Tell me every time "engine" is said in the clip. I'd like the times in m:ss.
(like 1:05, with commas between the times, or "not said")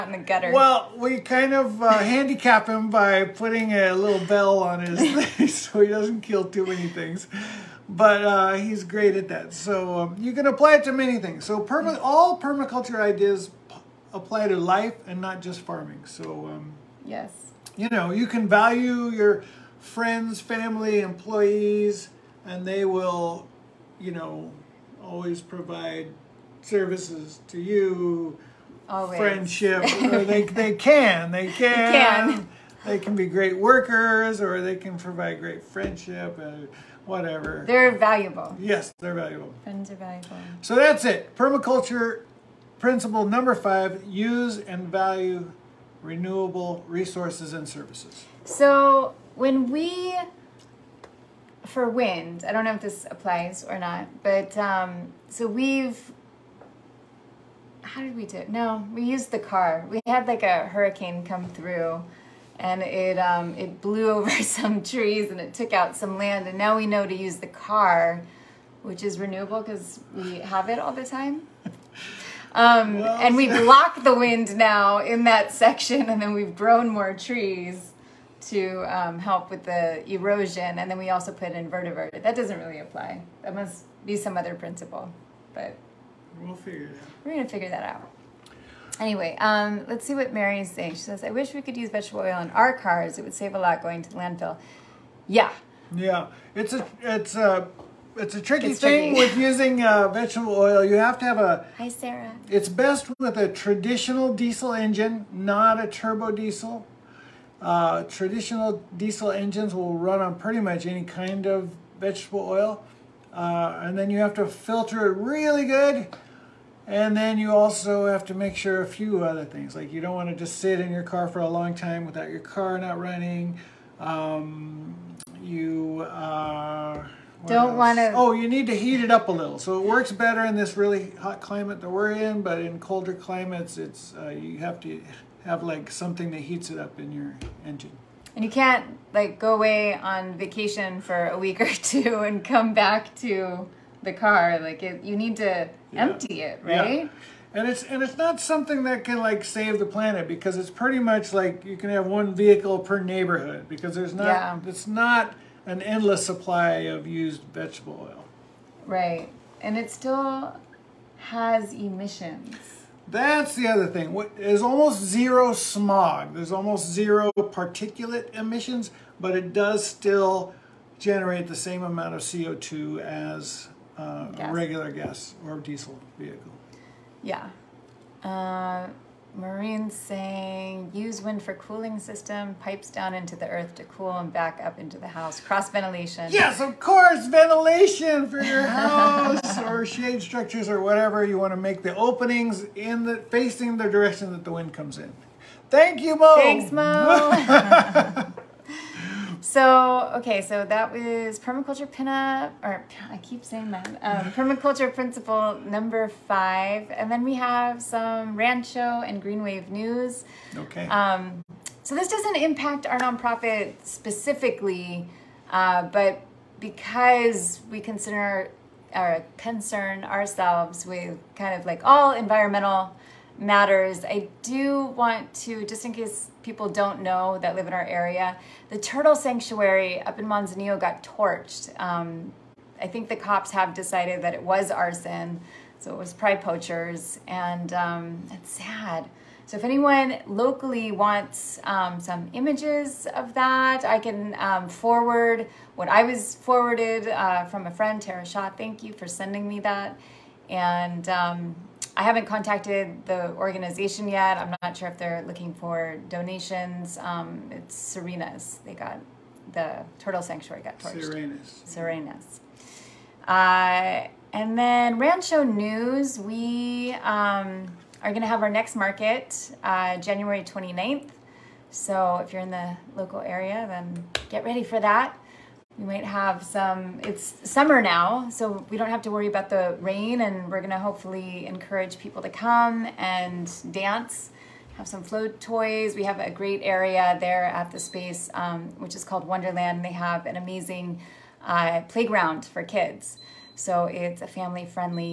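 1:44, 1:49, 2:17.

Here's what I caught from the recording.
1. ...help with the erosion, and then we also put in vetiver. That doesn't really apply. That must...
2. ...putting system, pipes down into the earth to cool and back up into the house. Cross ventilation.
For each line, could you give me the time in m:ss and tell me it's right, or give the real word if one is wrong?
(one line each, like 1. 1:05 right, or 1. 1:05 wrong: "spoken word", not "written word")
1. 1:19 right
2. 3:01 wrong: "cooling", not "putting".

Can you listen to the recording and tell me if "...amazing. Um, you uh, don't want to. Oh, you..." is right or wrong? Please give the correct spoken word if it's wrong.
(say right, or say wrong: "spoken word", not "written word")
wrong: "running", not "amazing".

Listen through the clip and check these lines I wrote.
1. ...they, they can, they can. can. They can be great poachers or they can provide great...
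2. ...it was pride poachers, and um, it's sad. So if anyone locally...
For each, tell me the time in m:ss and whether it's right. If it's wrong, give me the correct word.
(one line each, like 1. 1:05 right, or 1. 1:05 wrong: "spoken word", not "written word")
1. 0:30 wrong: "workers", not "poachers"
2. 3:55 right.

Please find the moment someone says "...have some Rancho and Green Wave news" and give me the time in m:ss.
3:27.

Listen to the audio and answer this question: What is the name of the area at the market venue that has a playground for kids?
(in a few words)
Wonderland.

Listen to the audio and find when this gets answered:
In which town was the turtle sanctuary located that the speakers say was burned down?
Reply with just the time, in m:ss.
3:50.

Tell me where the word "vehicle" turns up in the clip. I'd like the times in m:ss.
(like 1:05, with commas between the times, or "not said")
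2:32, 2:56.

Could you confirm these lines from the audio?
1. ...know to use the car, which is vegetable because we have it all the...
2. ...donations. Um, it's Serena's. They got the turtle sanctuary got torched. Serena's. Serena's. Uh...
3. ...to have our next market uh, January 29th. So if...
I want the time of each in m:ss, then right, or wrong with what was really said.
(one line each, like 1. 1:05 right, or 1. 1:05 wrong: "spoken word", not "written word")
1. 1:06 wrong: "renewable", not "vegetable"
2. 4:16 right
3. 4:28 right.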